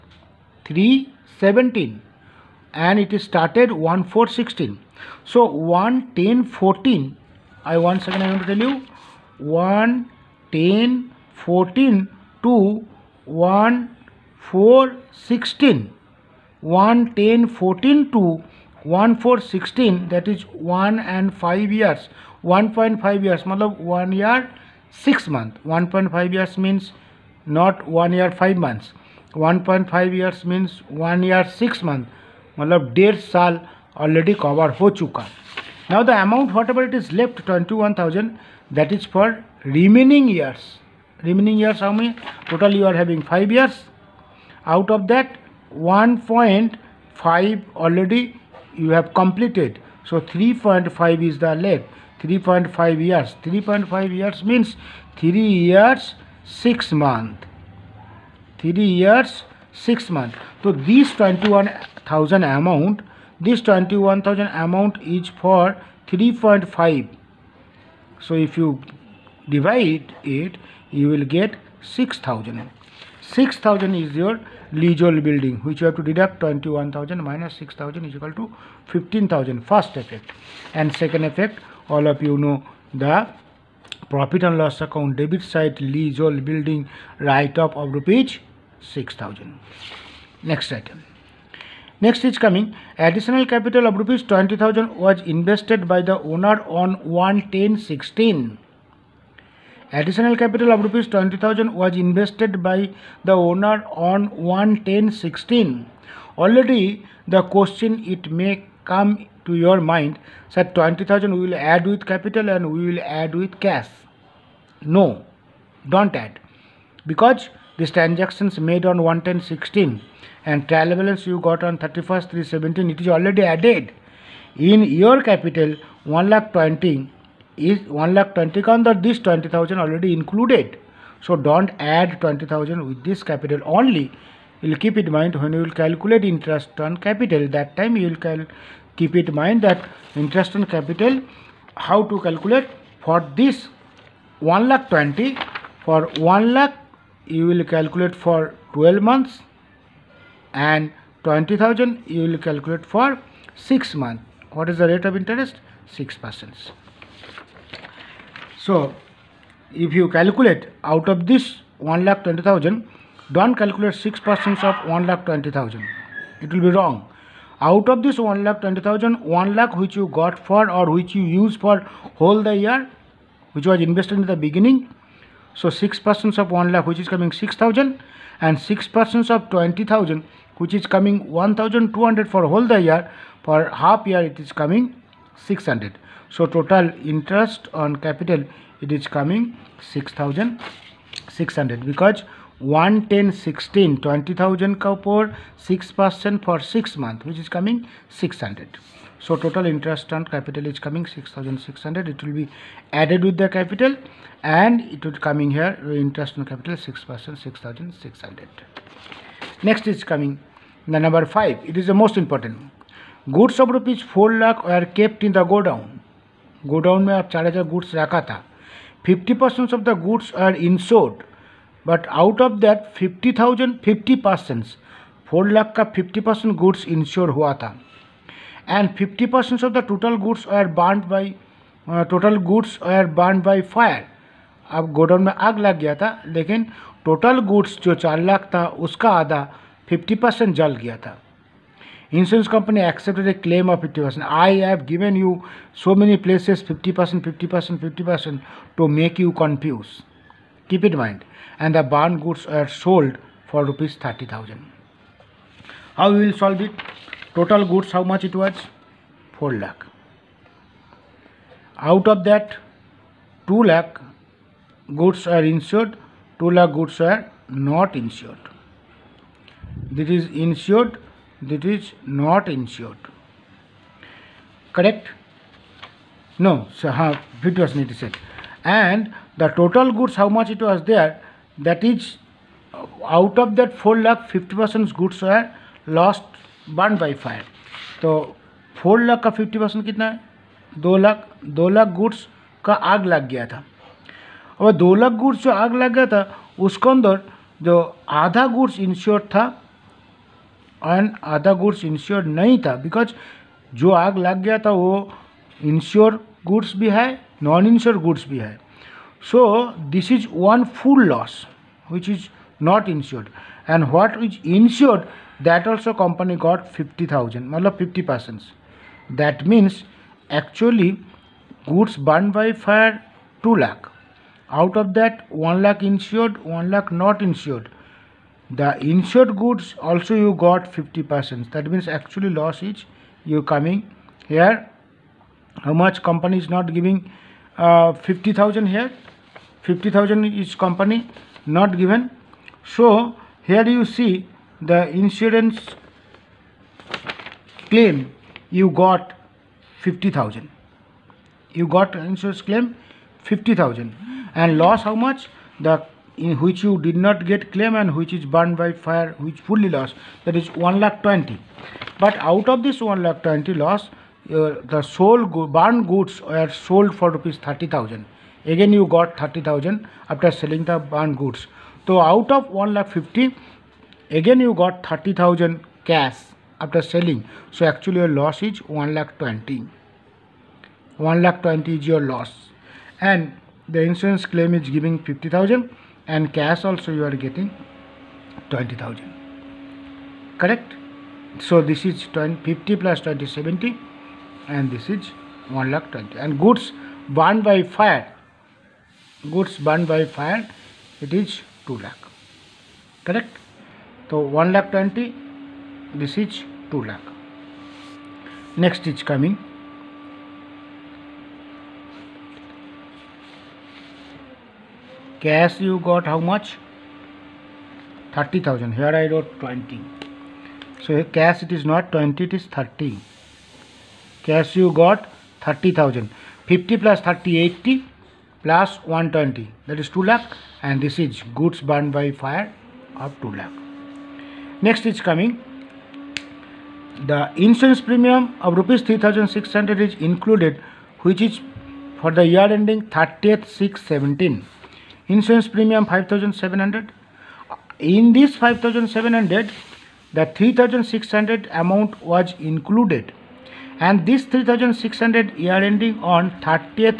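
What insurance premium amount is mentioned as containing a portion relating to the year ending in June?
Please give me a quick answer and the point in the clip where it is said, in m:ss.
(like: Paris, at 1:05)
3,600, at 7:17.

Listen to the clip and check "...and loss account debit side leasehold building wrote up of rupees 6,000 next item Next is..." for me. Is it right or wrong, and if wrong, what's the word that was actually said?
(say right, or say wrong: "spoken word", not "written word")
wrong: "write", not "wrote".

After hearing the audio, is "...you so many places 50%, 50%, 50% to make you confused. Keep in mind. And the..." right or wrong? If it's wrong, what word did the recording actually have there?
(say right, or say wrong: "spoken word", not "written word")
right.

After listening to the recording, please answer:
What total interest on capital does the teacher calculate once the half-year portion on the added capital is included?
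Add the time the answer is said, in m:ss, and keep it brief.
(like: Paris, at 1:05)
6,600, at 3:06.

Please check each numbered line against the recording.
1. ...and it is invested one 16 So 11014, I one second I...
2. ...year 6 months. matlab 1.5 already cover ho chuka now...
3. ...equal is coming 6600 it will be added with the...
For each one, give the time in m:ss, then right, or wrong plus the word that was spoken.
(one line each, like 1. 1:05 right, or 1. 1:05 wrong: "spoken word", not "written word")
1. 0:02 wrong: "started", not "invested"
2. 0:31 right
3. 3:20 wrong: "capital", not "equal".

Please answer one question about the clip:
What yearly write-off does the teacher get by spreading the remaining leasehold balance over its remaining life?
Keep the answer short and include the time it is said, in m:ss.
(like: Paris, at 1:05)
6,000, at 1:11.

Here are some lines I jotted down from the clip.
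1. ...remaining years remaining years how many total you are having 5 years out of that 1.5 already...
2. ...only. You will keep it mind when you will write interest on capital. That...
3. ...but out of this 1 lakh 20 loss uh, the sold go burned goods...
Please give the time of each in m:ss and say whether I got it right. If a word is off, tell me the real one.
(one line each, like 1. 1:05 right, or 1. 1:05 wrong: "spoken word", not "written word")
1. 0:39 right
2. 2:13 wrong: "calculate", not "write"
3. 6:01 right.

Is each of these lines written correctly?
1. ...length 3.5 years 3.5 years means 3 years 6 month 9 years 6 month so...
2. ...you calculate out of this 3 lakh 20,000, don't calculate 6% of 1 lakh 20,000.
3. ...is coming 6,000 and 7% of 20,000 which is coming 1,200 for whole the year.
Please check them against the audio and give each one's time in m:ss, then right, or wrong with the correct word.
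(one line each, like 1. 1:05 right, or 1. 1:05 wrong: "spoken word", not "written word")
1. 0:51 wrong: "3", not "9"
2. 2:39 wrong: "1", not "3"
3. 2:56 wrong: "6", not "7".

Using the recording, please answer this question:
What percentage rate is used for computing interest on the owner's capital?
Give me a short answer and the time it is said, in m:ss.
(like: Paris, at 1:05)
6 percent, at 2:35.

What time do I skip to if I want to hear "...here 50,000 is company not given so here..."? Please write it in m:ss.
5:38.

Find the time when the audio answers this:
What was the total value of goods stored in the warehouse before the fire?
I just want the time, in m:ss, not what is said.
3:33.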